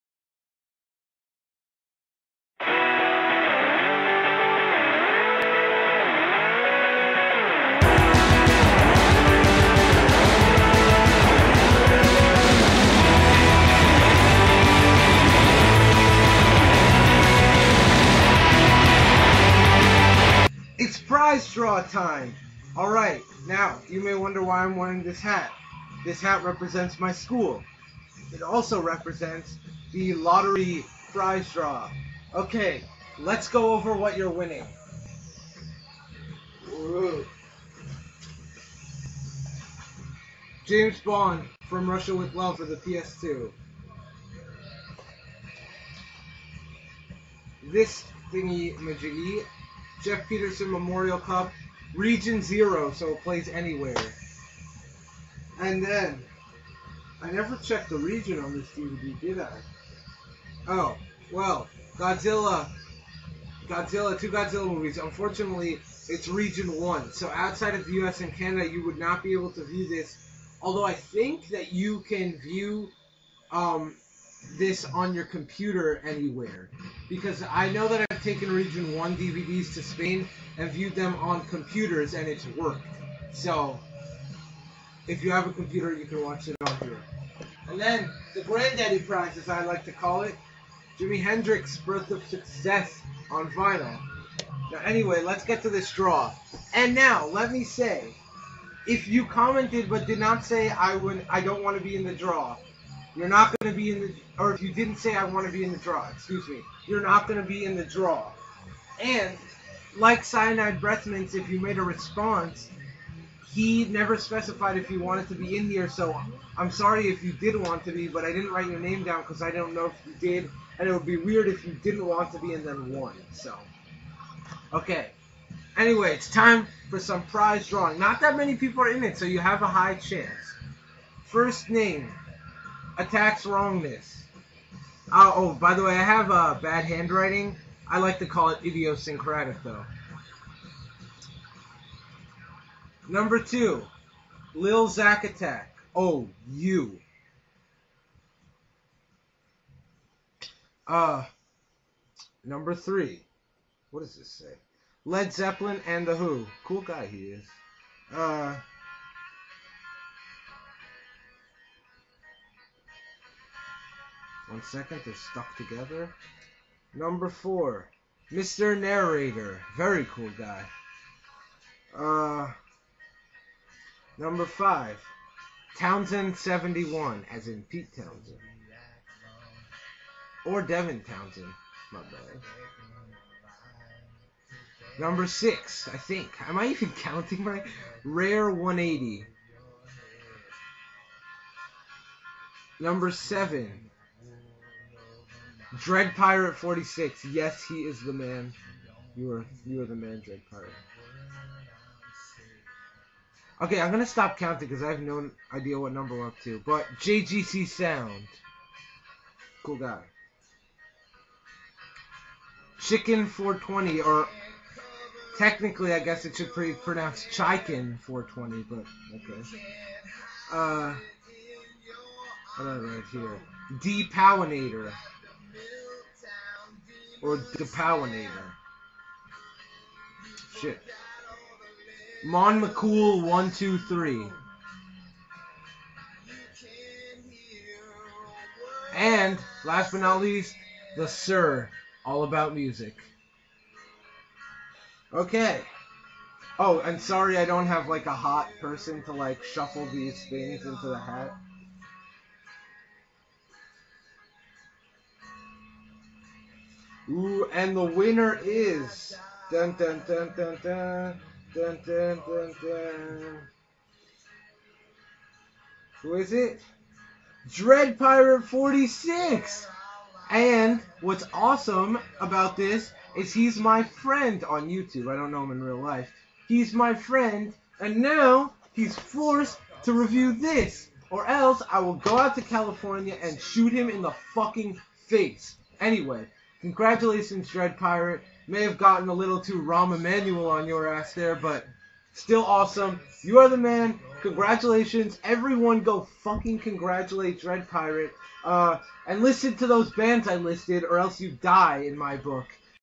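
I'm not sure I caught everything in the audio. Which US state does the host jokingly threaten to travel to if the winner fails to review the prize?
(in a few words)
California.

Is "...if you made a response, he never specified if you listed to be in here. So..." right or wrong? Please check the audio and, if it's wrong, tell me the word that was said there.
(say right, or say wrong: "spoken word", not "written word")
wrong: "wanted", not "listed".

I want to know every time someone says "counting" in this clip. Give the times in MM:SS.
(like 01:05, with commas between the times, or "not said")
03:07, 03:24.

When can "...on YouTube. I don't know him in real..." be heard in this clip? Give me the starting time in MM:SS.
04:34.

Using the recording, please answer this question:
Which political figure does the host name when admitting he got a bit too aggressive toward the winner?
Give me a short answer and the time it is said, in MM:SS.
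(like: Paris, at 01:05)
Rahm Emanuel, at 04:49.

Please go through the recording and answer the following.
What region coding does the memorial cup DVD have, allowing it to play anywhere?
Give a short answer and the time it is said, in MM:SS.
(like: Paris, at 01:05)
Region Zero, at 00:51.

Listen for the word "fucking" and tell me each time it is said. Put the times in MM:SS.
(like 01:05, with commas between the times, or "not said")
04:44, 04:56.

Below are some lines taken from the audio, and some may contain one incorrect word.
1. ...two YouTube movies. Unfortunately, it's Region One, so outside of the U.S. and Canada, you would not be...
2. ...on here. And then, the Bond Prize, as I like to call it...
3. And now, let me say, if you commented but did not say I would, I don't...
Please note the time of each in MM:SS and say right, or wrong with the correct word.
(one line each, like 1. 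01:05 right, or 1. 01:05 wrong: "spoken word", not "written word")
1. 01:04 wrong: "Godzilla", not "YouTube"
2. 01:26 wrong: "Granddaddy", not "Bond"
3. 01:36 right.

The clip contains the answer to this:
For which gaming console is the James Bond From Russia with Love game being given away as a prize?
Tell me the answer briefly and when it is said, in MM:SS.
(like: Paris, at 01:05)
PS2, at 00:42.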